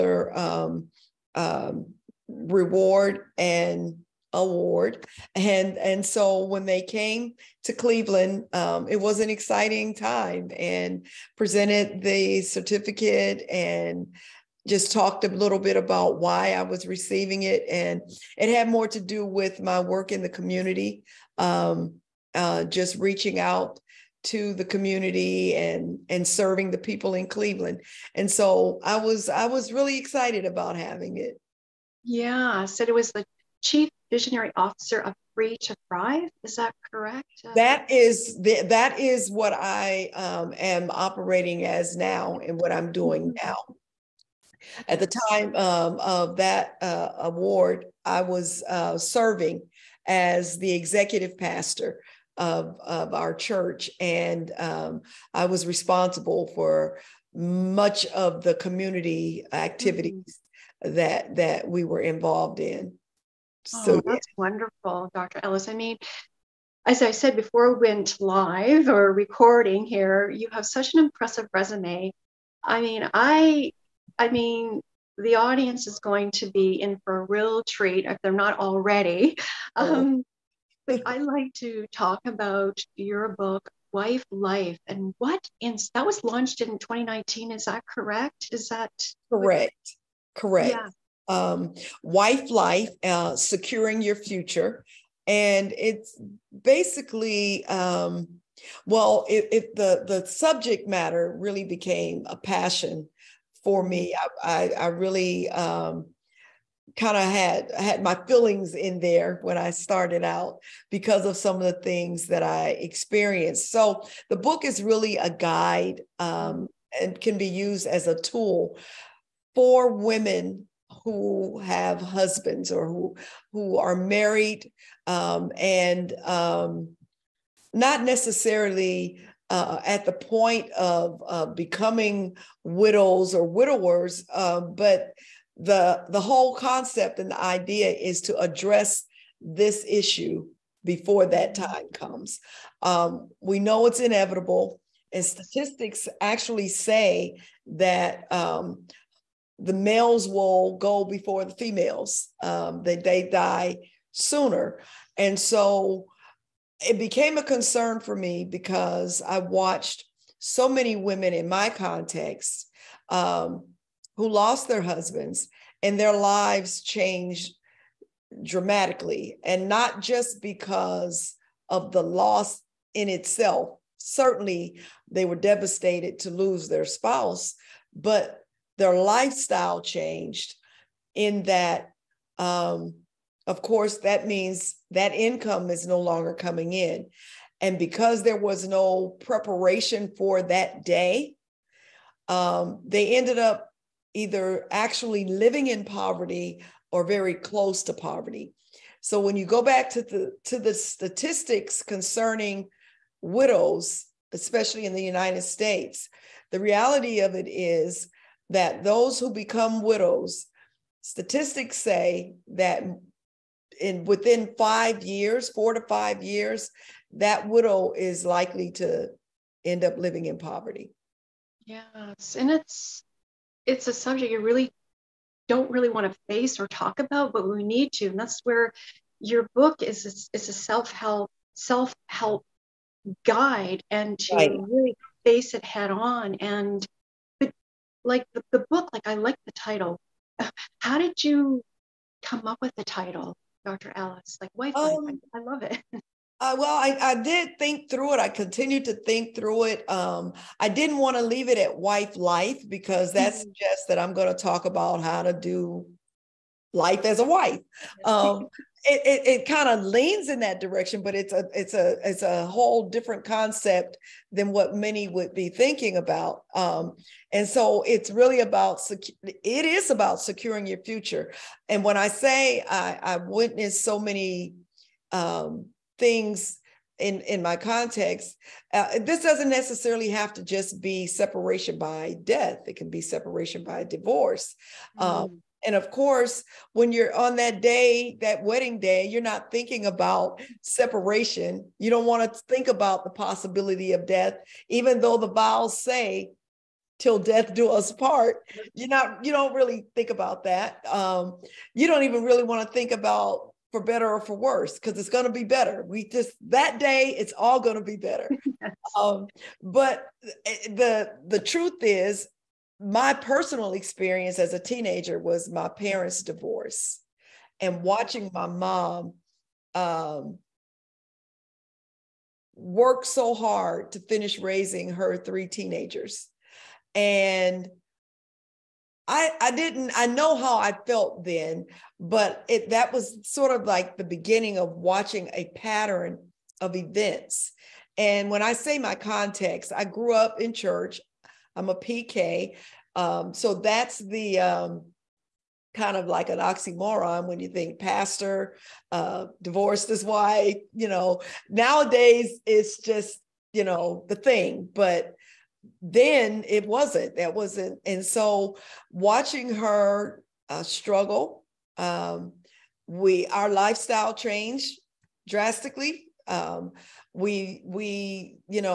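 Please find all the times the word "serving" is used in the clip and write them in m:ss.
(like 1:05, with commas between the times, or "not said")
0:26, 0:48.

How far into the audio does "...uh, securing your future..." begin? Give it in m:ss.
1:33.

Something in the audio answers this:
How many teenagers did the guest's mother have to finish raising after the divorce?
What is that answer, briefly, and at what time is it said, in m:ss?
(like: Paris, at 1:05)
3, at 5:25.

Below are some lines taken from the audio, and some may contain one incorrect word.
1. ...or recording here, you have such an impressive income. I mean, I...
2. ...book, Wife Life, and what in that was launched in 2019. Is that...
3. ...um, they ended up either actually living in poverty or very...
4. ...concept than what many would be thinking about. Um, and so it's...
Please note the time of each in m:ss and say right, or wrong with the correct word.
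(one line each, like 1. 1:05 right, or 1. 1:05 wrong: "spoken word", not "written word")
1. 1:08 wrong: "resume", not "income"
2. 1:23 right
3. 3:12 right
4. 4:23 right.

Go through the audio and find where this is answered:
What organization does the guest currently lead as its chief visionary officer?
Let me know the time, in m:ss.
0:35.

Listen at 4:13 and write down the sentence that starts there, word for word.
suggests that I'm going to talk about how to do life as a wife.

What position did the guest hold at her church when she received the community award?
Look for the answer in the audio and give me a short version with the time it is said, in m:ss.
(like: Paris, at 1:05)
Executive pastor, at 0:50.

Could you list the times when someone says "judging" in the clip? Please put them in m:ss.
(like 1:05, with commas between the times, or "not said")
not said.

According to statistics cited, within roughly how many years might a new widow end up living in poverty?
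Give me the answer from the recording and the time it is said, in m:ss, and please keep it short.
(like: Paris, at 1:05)
4 to 5 years, at 3:35.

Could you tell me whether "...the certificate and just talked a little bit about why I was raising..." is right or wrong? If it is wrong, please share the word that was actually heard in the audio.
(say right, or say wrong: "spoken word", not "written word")
wrong: "receiving", not "raising".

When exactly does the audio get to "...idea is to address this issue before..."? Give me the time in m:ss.
2:17.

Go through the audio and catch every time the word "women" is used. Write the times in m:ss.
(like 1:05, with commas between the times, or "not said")
1:59, 2:40.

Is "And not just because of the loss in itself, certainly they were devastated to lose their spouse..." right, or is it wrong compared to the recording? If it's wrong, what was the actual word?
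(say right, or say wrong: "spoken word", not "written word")
right.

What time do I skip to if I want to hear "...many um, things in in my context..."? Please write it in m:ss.
4:33.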